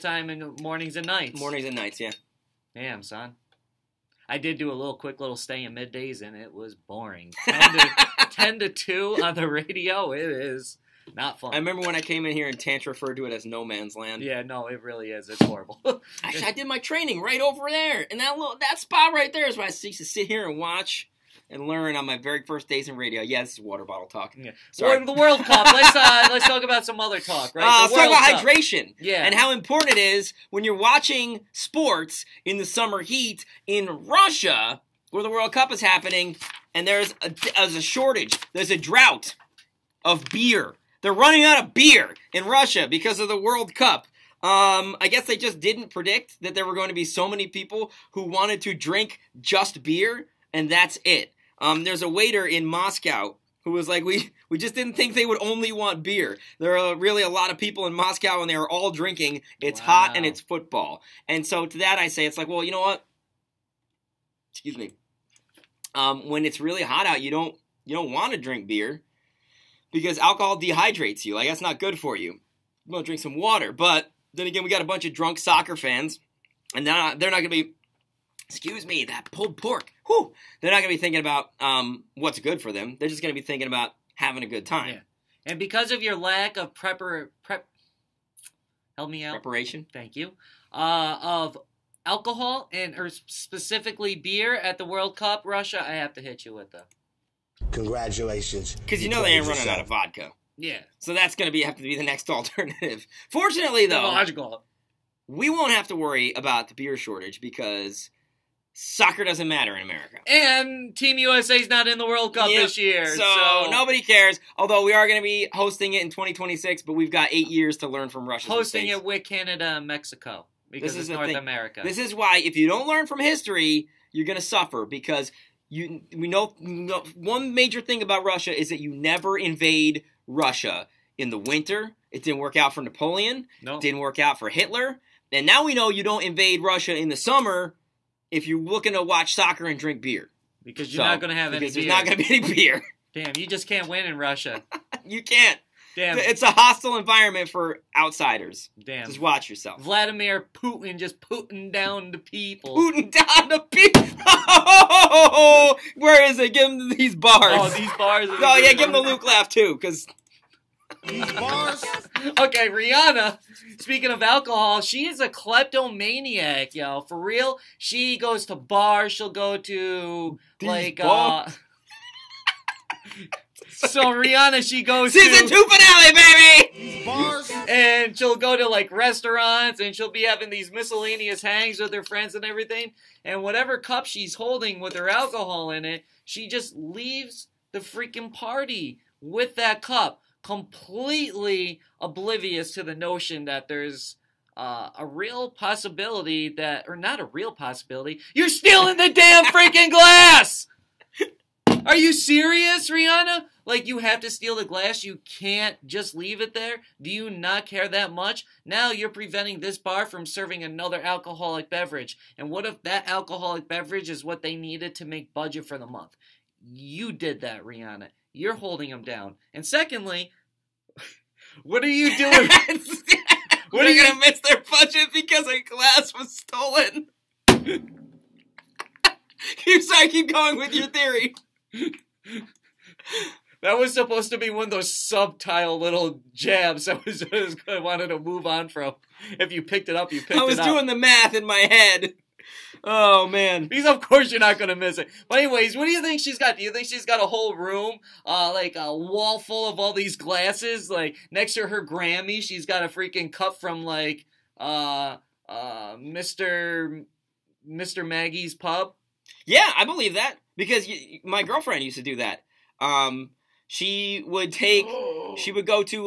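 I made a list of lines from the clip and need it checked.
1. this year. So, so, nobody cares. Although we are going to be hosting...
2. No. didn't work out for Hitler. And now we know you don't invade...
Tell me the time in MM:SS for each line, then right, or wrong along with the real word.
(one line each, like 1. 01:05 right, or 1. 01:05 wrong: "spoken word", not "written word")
1. 01:52 right
2. 02:13 right.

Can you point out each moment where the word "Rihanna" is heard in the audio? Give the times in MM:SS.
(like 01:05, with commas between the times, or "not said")
02:42, 02:54, 03:22, 03:37.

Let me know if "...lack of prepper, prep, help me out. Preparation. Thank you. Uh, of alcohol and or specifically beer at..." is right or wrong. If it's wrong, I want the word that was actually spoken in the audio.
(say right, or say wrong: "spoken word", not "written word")
right.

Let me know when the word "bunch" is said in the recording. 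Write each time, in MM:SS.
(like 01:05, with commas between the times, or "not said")
01:14.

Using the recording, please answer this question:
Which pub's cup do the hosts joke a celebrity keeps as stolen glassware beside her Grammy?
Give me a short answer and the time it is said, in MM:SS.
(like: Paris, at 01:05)
Mister Maggie's pub, at 04:17.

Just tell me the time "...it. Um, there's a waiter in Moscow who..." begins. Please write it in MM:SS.
00:51.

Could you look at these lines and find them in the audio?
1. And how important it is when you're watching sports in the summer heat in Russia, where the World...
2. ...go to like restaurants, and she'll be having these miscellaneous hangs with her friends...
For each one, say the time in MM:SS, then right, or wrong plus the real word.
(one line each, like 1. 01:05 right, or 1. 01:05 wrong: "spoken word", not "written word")
1. 00:29 right
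2. 02:58 right.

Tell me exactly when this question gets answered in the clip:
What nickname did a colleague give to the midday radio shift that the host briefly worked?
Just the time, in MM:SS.
00:13.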